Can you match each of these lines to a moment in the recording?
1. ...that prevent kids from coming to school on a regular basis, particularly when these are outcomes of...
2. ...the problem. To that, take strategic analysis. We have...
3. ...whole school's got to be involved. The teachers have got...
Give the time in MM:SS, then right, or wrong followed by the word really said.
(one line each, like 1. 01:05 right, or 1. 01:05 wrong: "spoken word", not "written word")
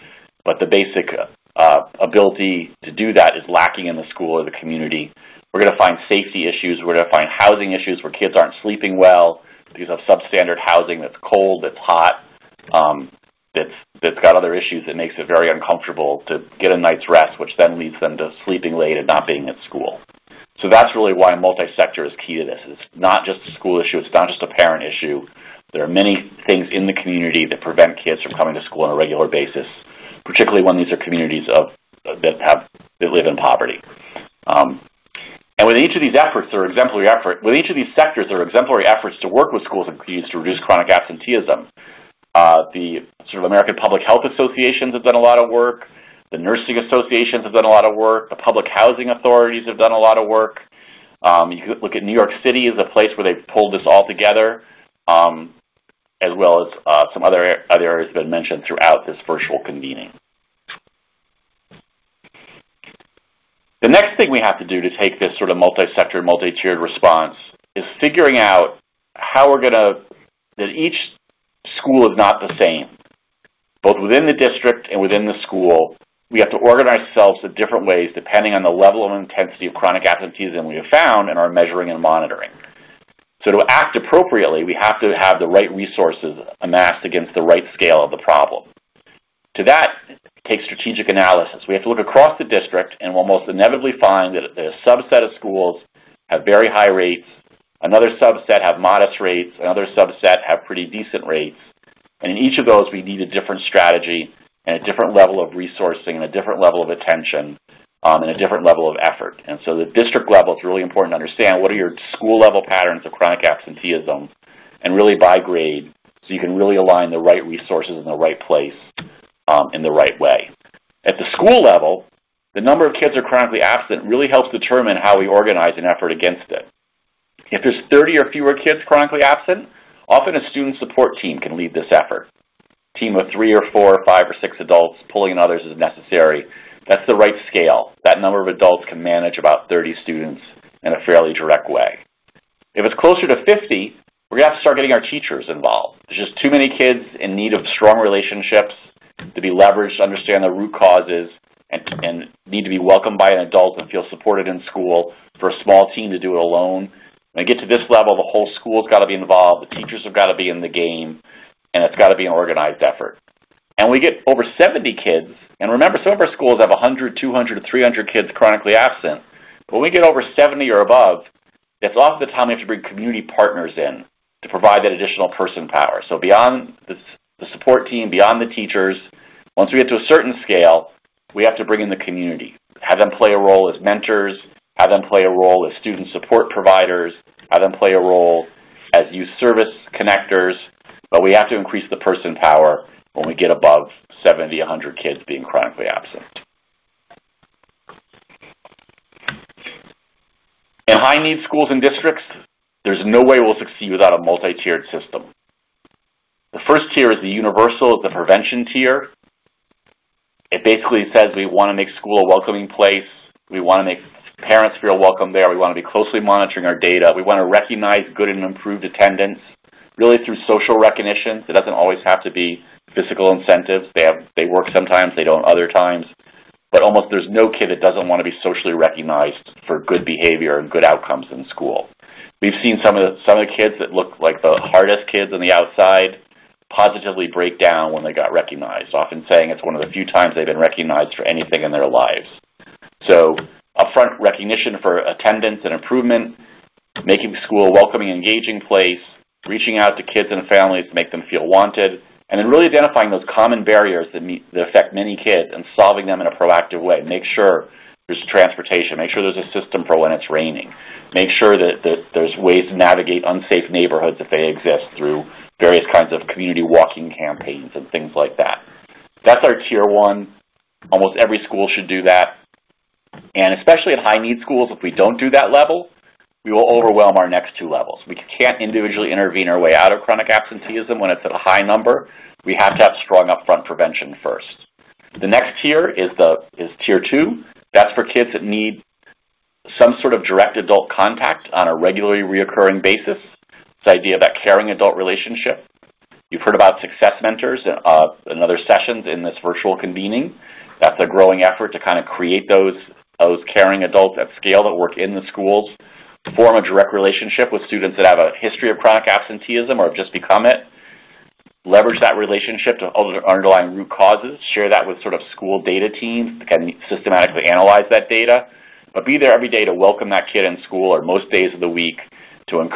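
1. 00:27 wrong: "communities", not "outcomes"
2. 01:28 right
3. 02:38 right.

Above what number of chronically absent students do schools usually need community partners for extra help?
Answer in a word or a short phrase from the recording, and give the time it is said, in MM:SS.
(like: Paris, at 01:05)
70, at 02:50.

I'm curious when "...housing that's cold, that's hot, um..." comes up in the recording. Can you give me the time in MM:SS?
00:10.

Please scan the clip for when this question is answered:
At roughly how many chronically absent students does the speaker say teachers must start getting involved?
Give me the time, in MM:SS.
02:22.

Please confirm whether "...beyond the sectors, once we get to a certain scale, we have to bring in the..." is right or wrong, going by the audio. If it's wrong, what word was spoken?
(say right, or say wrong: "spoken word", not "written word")
wrong: "teachers", not "sectors".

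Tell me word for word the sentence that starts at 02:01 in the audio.
At the school level, the number of kids who are chronically absent really helps determine how we organize an effort against it.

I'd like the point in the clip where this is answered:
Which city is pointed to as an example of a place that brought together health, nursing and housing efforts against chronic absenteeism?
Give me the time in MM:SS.
00:52.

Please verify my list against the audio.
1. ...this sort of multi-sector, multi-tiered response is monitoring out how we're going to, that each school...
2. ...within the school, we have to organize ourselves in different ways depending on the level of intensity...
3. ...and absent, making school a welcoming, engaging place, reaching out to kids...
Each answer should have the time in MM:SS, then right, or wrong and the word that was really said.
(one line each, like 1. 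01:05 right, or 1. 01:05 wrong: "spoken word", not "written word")
1. 01:05 wrong: "figuring", not "monitoring"
2. 01:14 right
3. 04:05 wrong: "improvement", not "absent".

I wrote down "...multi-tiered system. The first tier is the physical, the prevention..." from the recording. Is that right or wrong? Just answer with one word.
wrong.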